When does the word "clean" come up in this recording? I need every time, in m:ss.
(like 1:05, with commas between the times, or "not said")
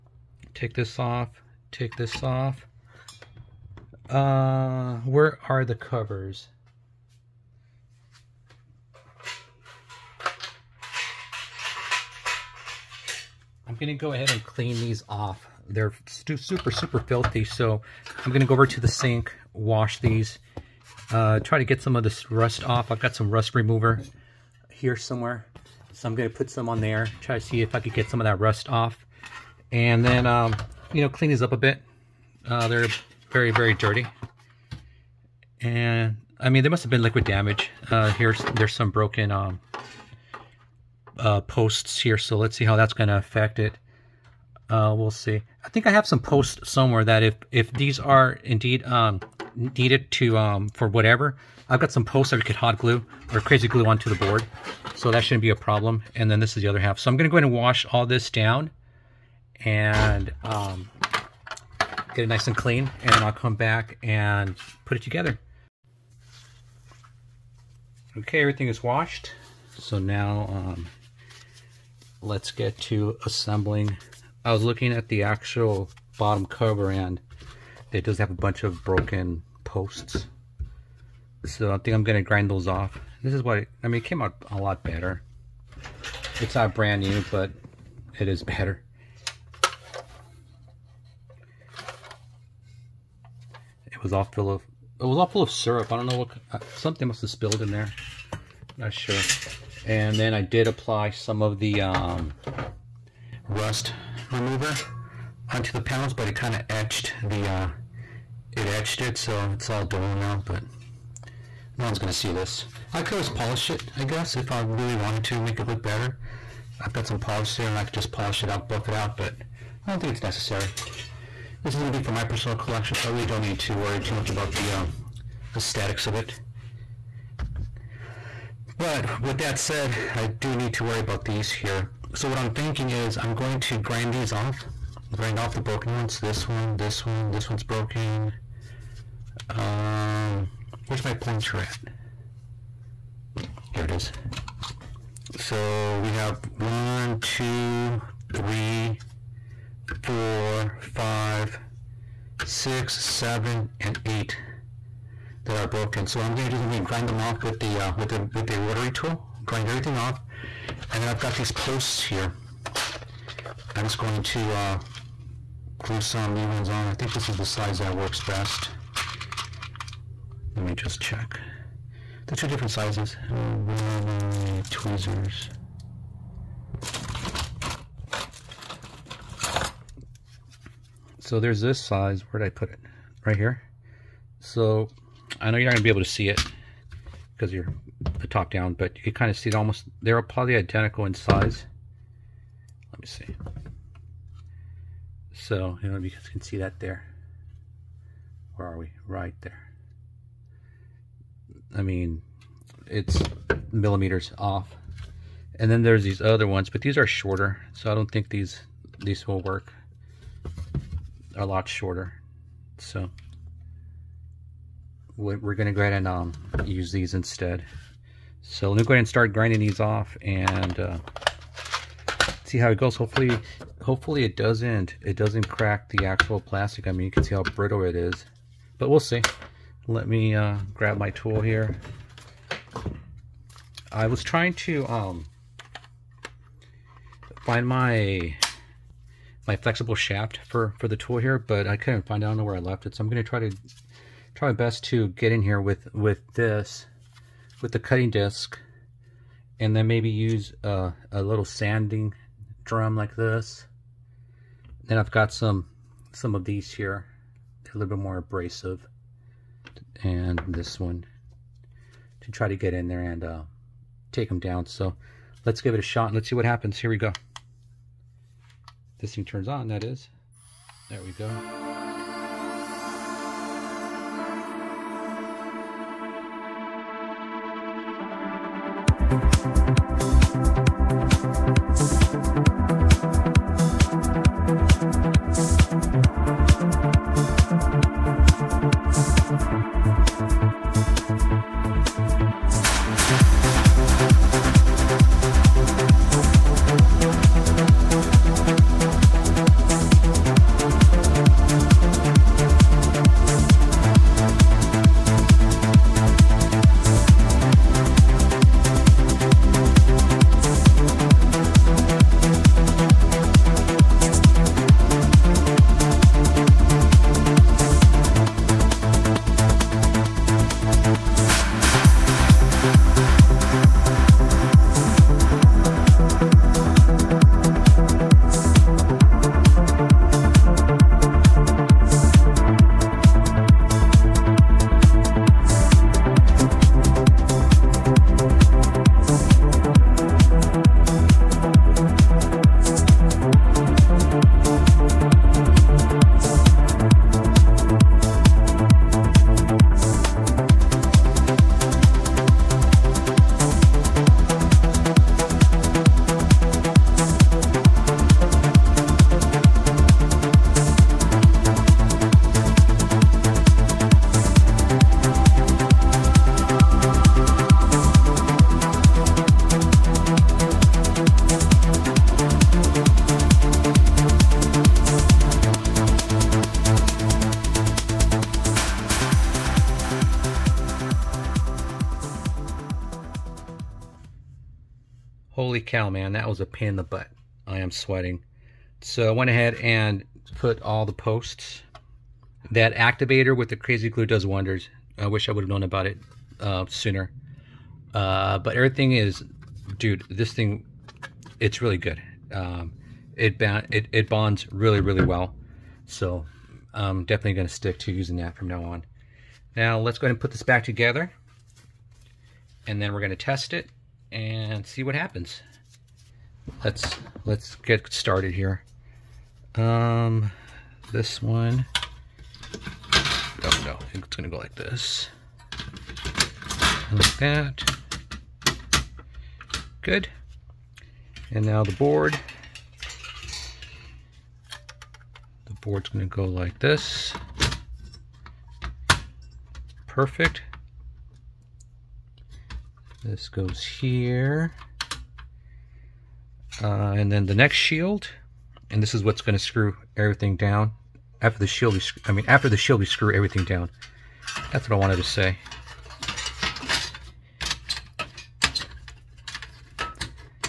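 0:14, 0:31, 1:02.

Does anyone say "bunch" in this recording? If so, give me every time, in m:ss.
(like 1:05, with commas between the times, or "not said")
1:18.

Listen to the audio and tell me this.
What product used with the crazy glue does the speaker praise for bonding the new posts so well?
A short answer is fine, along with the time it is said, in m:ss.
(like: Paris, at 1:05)
Activator, at 6:32.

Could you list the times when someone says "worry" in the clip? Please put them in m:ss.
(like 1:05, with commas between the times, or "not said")
2:03, 2:10.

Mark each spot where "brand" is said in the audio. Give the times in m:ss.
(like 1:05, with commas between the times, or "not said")
1:26.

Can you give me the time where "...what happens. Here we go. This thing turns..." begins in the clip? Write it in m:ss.
4:26.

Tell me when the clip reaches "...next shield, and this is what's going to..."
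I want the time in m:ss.
7:27.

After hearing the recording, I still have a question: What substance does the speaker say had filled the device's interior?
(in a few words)
Syrup.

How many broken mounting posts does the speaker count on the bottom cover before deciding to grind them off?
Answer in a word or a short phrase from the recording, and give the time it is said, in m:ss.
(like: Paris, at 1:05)
8, at 2:34.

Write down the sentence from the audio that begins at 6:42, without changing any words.
Um, it, it, it bonds really, really well.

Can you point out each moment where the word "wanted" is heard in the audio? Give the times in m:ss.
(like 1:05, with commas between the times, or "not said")
1:54, 7:34.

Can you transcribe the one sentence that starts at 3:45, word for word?
It doesn't crack the actual plastic.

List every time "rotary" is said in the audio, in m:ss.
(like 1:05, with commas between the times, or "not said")
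2:38.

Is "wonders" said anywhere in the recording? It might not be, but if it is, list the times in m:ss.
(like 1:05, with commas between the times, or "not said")
6:34.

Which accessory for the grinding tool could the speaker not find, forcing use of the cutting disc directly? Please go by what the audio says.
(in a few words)
Flexible shaft.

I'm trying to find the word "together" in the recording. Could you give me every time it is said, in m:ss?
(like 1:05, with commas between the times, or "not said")
1:05, 6:50.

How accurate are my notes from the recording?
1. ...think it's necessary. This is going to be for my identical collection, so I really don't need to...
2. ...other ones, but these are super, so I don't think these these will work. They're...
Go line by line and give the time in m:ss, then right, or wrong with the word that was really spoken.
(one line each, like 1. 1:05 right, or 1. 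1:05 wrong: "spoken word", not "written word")
1. 1:59 wrong: "personal", not "identical"
2. 3:26 wrong: "shorter", not "super".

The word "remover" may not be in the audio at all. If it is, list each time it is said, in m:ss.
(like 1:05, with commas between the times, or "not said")
0:23, 1:44.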